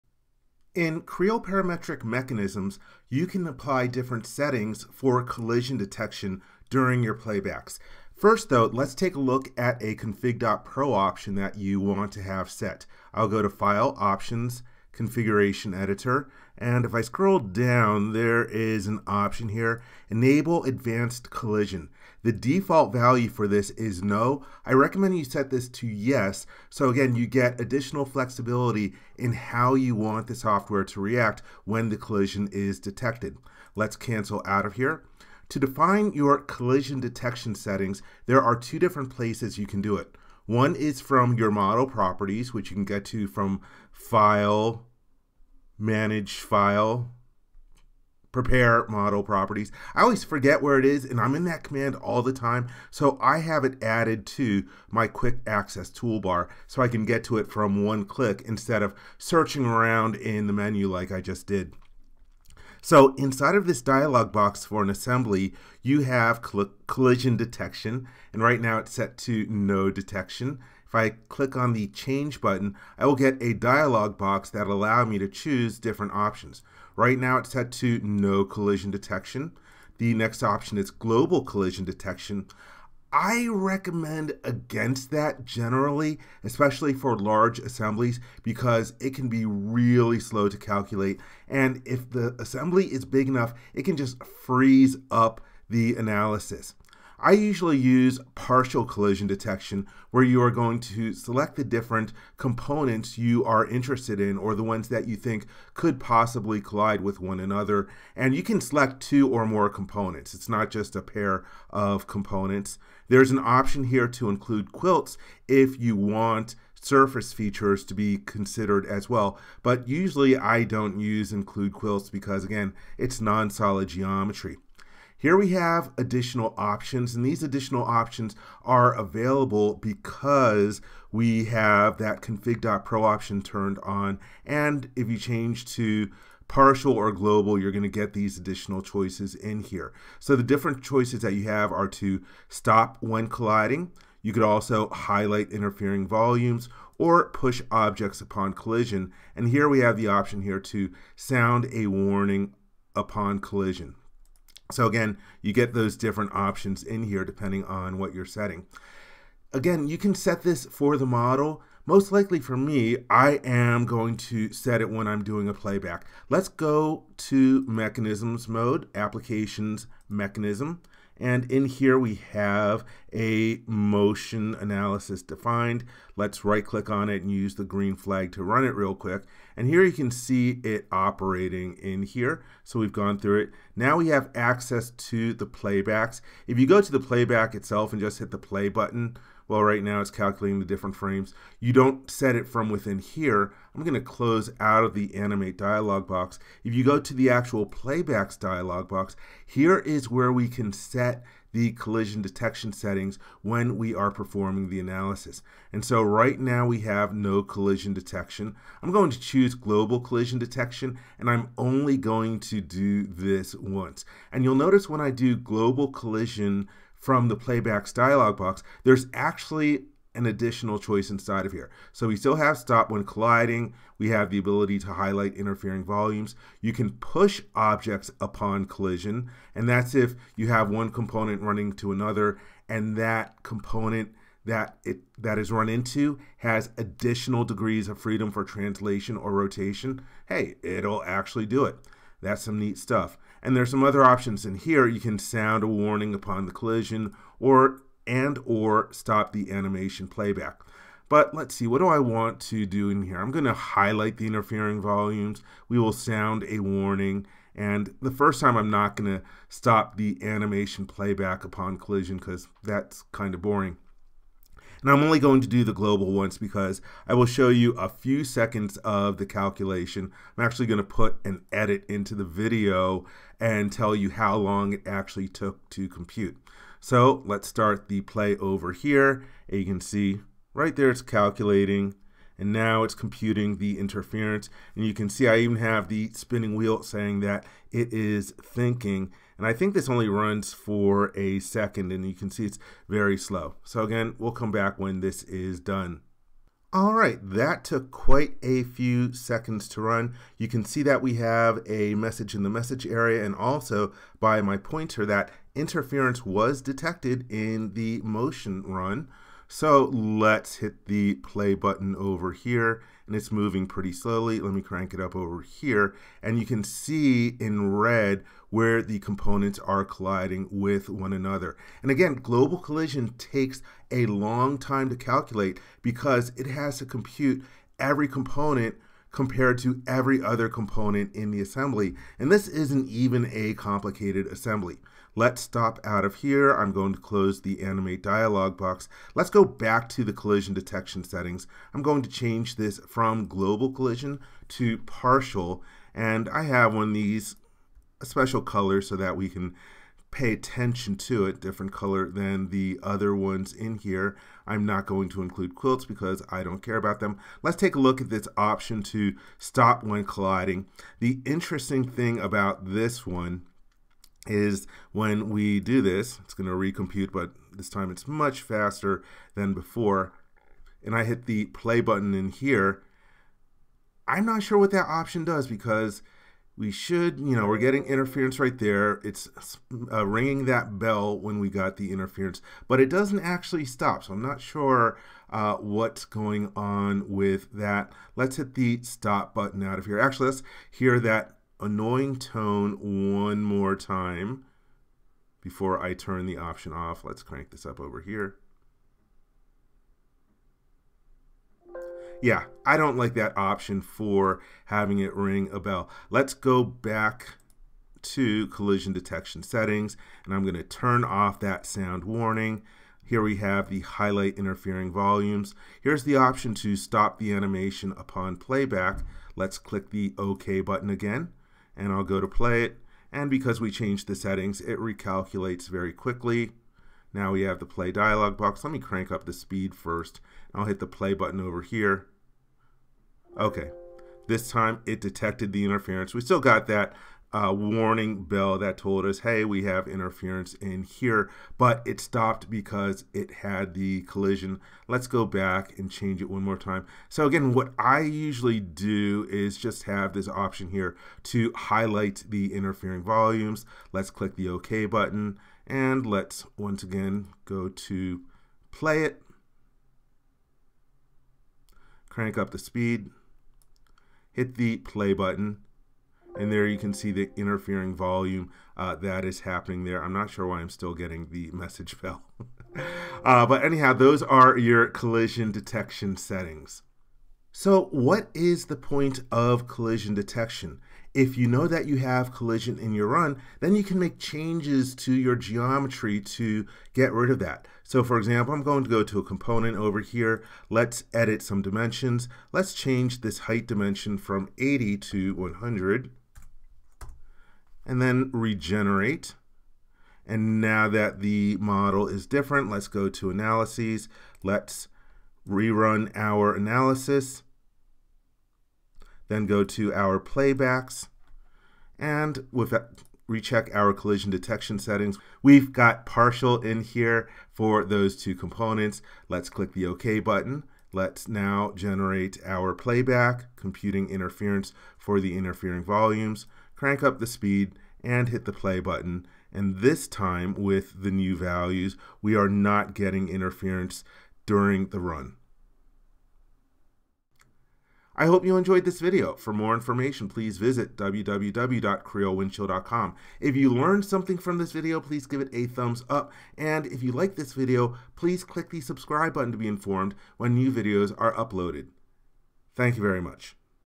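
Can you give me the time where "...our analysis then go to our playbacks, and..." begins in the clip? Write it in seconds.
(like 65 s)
506 s.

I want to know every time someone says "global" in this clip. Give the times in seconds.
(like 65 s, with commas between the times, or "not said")
80 s, 137 s, 209 s, 215 s, 265 s, 322 s, 343 s.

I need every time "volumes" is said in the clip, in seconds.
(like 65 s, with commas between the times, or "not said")
146 s, 225 s, 254 s, 414 s, 453 s, 467 s, 525 s.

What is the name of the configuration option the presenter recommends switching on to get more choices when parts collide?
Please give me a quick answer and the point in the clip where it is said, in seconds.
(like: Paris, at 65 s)
enable advanced collision, at 20 s.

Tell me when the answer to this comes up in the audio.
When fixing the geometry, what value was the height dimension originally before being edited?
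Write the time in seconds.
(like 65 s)
494 s.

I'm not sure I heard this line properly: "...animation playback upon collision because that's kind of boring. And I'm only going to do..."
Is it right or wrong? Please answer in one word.
right.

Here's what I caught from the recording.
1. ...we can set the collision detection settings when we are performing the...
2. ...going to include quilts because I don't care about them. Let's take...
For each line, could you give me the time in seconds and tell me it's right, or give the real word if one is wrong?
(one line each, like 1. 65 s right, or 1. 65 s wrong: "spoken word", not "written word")
1. 200 s right
2. 354 s right.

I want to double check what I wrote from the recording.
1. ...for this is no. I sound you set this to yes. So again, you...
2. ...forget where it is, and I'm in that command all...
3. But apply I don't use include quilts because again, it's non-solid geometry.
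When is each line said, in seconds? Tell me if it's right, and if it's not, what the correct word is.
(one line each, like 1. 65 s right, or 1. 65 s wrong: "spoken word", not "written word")
1. 23 s wrong: "recommend", not "sound"
2. 50 s right
3. 119 s wrong: "usually", not "apply".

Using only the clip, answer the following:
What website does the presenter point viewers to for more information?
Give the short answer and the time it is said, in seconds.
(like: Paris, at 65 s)
www.creowindchill.com, at 540 s.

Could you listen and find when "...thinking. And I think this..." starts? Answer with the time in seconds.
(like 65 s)
288 s.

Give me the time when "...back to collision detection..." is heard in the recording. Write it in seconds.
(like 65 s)
406 s.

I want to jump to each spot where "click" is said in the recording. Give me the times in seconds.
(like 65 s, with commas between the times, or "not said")
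58 s, 71 s, 176 s, 419 s, 454 s, 519 s, 548 s.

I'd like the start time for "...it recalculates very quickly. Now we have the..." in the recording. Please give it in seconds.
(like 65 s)
424 s.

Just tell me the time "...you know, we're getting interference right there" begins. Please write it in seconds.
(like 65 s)
377 s.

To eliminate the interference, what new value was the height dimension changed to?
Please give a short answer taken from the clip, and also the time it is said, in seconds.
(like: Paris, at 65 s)
100, at 494 s.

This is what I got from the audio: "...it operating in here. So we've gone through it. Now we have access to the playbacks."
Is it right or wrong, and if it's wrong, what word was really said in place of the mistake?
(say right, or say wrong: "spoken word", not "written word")
right.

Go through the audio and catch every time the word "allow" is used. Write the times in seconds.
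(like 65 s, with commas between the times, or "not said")
74 s.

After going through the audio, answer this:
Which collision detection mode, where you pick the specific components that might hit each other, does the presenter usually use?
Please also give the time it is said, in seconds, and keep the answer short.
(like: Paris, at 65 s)
partial collision detection, at 98 s.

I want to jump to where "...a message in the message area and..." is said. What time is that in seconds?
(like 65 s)
301 s.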